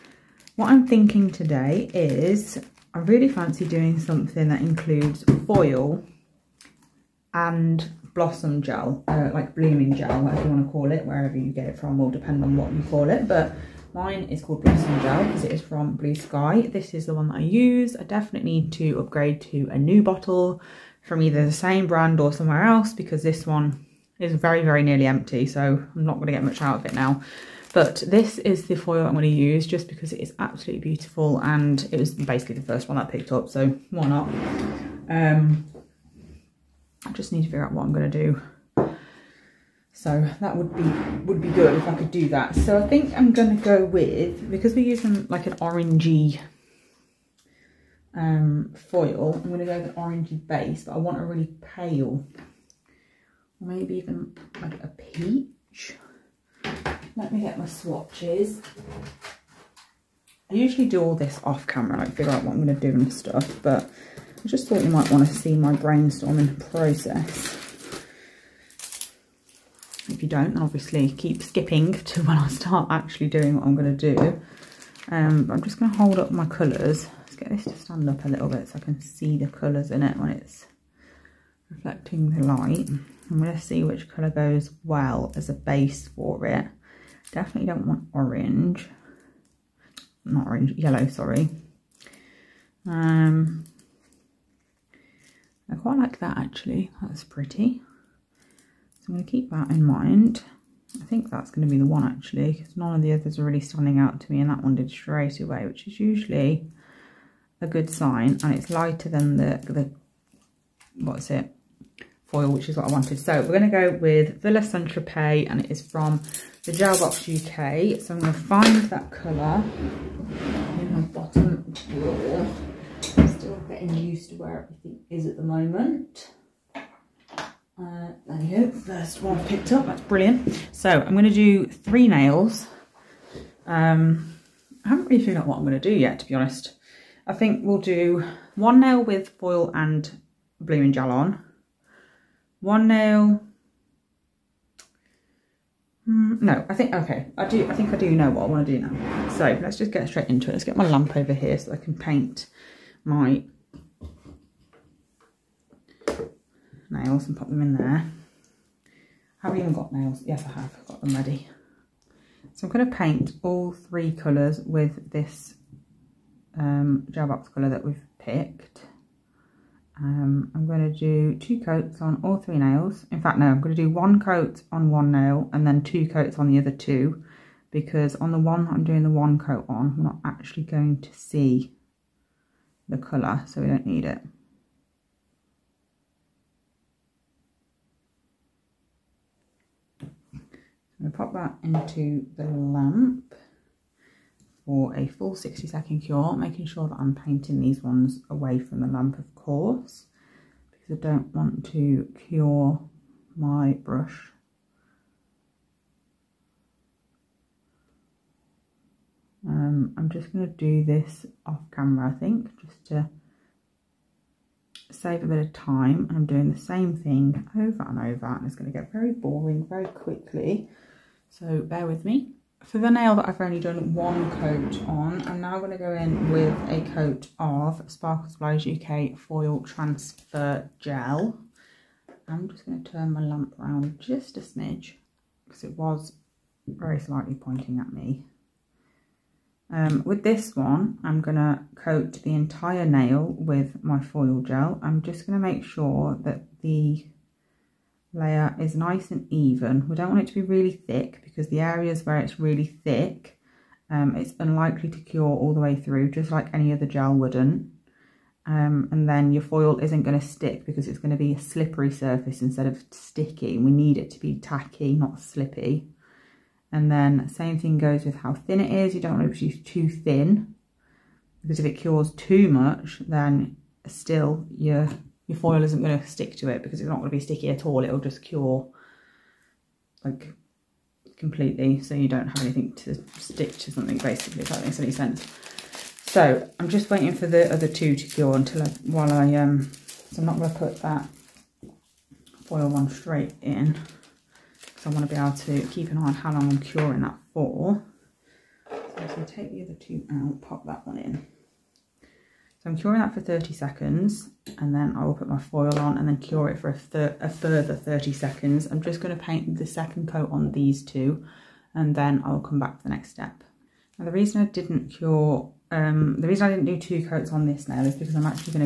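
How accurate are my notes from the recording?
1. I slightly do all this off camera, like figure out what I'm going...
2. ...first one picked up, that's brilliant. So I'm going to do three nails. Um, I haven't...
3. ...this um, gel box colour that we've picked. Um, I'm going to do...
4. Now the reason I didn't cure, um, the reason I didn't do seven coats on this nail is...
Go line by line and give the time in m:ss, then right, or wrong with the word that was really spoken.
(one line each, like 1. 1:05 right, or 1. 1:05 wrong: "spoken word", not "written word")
1. 1:00 wrong: "usually", not "slightly"
2. 2:08 right
3. 2:45 right
4. 5:13 wrong: "two", not "seven".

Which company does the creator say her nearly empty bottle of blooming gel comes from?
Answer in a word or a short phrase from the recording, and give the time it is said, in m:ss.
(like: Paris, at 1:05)
Bluesky, at 0:15.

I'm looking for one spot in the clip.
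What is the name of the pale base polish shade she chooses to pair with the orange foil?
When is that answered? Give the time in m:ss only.
1:54.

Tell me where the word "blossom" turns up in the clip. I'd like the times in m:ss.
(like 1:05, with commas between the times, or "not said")
0:08, 0:14.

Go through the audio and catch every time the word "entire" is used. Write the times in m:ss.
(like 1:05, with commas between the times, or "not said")
4:02.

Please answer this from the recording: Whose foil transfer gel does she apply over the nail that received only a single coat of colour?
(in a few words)
Sparkle Supplies UK.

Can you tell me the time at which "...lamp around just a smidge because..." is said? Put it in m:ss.
3:53.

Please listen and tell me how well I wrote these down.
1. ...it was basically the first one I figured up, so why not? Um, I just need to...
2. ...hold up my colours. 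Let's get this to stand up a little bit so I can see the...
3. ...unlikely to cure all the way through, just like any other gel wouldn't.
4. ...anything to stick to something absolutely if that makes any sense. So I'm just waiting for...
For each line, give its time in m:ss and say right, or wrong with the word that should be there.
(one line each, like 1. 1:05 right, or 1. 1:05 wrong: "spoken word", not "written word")
1. 0:31 wrong: "picked", not "figured"
2. 1:15 right
3. 4:14 right
4. 4:42 wrong: "basically", not "absolutely".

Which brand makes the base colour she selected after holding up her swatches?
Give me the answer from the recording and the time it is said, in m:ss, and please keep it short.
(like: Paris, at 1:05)
Gelbox UK, at 1:56.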